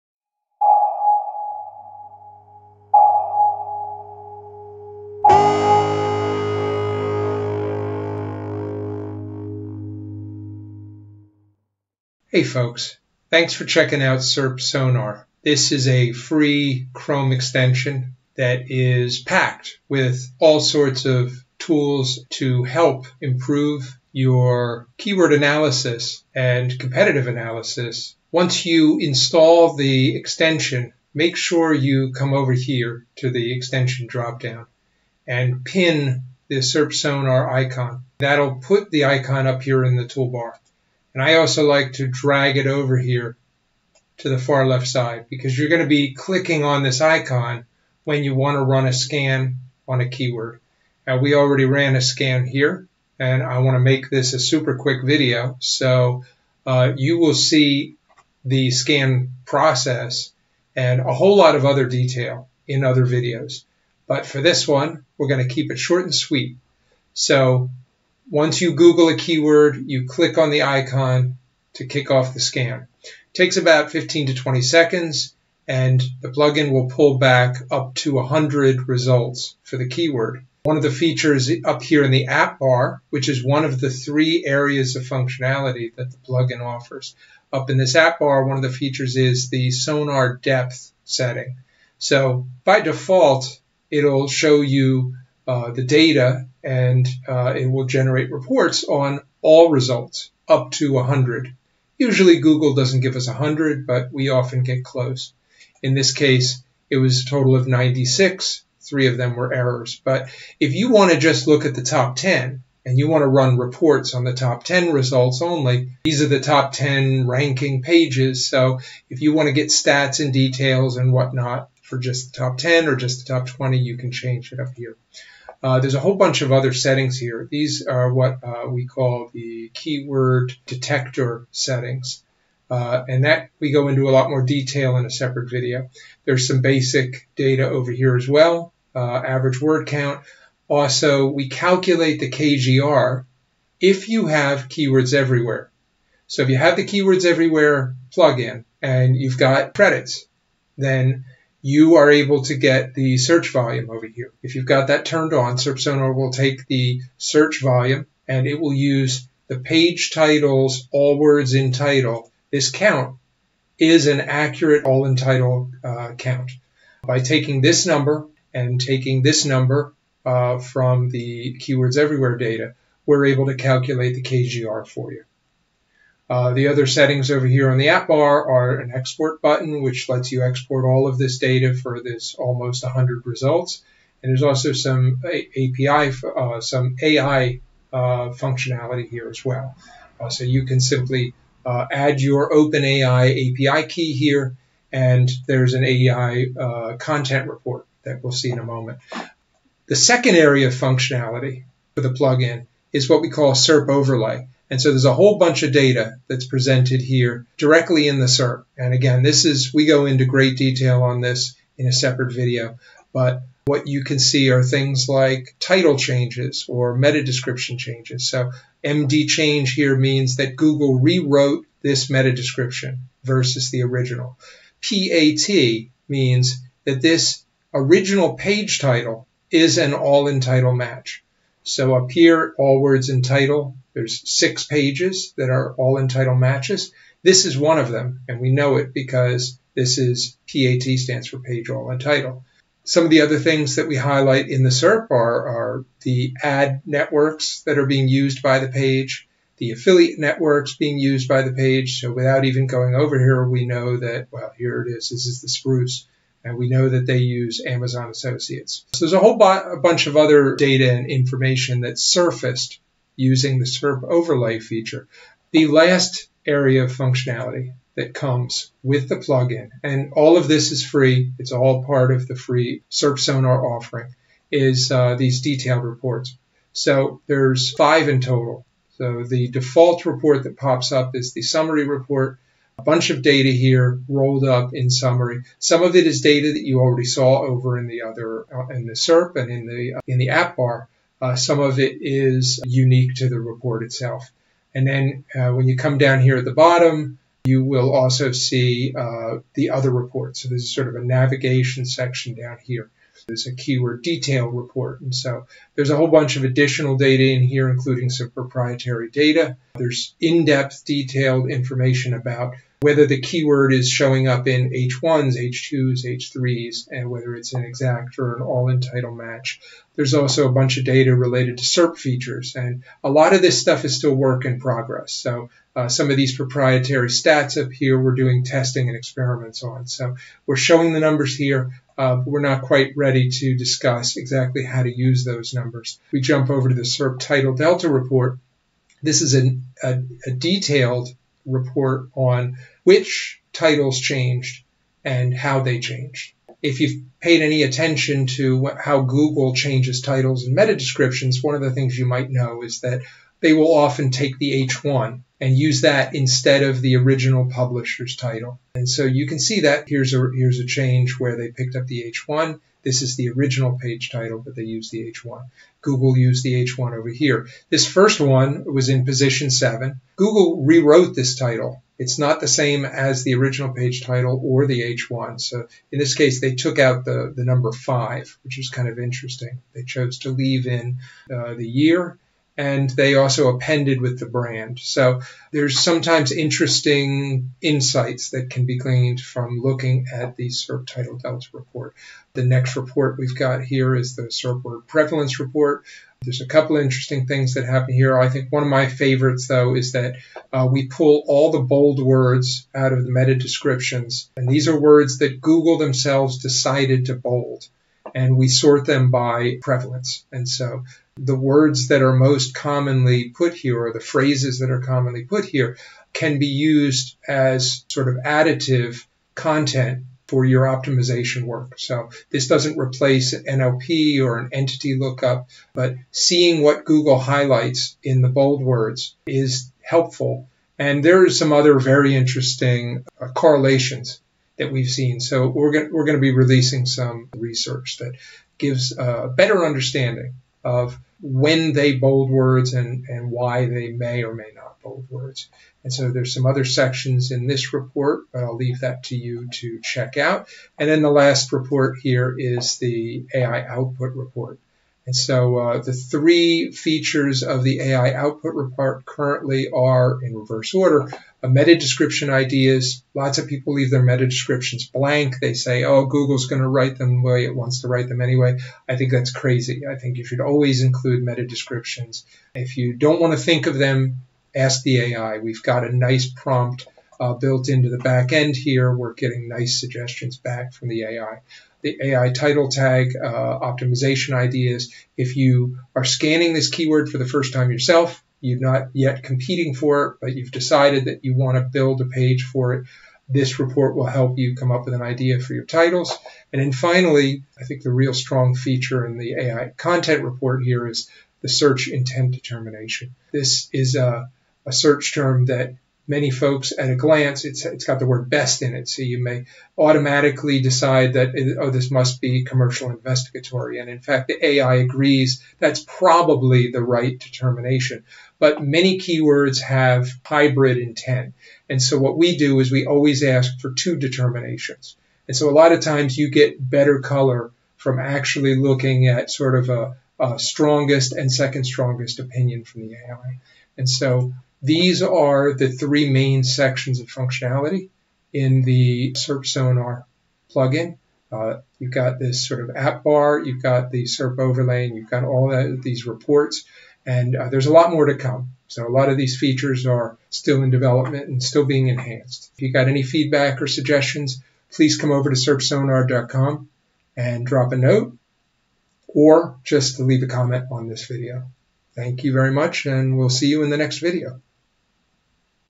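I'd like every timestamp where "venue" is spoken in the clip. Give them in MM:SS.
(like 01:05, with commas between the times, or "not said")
not said.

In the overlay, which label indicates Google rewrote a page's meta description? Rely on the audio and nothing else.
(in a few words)
MD change.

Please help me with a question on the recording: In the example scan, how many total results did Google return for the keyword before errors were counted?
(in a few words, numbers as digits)
96.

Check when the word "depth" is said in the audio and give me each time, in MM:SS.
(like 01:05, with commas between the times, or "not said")
01:30, 05:10.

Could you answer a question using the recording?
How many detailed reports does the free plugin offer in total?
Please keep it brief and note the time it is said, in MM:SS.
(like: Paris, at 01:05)
5, at 04:37.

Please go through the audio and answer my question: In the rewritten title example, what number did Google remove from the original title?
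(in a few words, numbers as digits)
5.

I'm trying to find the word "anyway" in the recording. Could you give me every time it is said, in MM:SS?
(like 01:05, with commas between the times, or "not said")
07:48.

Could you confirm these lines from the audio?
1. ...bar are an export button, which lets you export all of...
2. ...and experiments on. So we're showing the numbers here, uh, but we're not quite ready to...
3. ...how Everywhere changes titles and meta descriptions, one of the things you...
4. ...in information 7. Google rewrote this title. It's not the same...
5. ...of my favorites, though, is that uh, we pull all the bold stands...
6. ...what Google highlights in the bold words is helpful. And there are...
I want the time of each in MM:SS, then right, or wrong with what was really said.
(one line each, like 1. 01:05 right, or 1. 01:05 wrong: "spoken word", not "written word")
1. 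02:58 right
2. 05:28 right
3. 05:48 wrong: "Google", not "Everywhere"
4. 06:08 wrong: "position", not "information"
5. 06:38 wrong: "words", not "stands"
6. 07:06 right.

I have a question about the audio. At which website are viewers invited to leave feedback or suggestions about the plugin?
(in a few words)
SERPsonar.com.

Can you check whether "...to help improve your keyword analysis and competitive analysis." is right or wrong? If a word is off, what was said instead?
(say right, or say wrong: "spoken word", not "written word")
right.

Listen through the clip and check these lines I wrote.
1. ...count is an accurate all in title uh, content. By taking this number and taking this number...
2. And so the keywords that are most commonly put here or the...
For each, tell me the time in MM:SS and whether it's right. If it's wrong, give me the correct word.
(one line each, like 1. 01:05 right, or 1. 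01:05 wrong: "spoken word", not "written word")
1. 02:42 wrong: "count", not "content"
2. 06:50 wrong: "words", not "keywords".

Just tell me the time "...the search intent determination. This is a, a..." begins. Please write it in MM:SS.
08:21.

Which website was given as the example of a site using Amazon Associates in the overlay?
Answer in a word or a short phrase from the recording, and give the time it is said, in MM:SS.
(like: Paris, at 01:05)
The Spruce, at 04:15.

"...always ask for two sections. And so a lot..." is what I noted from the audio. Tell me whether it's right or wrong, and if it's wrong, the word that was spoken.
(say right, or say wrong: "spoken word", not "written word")
wrong: "determinations", not "sections".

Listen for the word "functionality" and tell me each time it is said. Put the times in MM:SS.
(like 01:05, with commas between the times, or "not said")
01:25, 03:08, 03:20, 04:26, 08:57.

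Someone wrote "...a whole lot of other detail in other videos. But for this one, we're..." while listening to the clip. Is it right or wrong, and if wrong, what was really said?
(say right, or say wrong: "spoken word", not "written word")
right.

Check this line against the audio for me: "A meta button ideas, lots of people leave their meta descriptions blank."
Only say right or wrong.
wrong.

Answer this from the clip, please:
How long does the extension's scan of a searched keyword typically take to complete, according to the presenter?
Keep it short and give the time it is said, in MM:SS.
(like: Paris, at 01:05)
15 to 20 seconds, at 01:13.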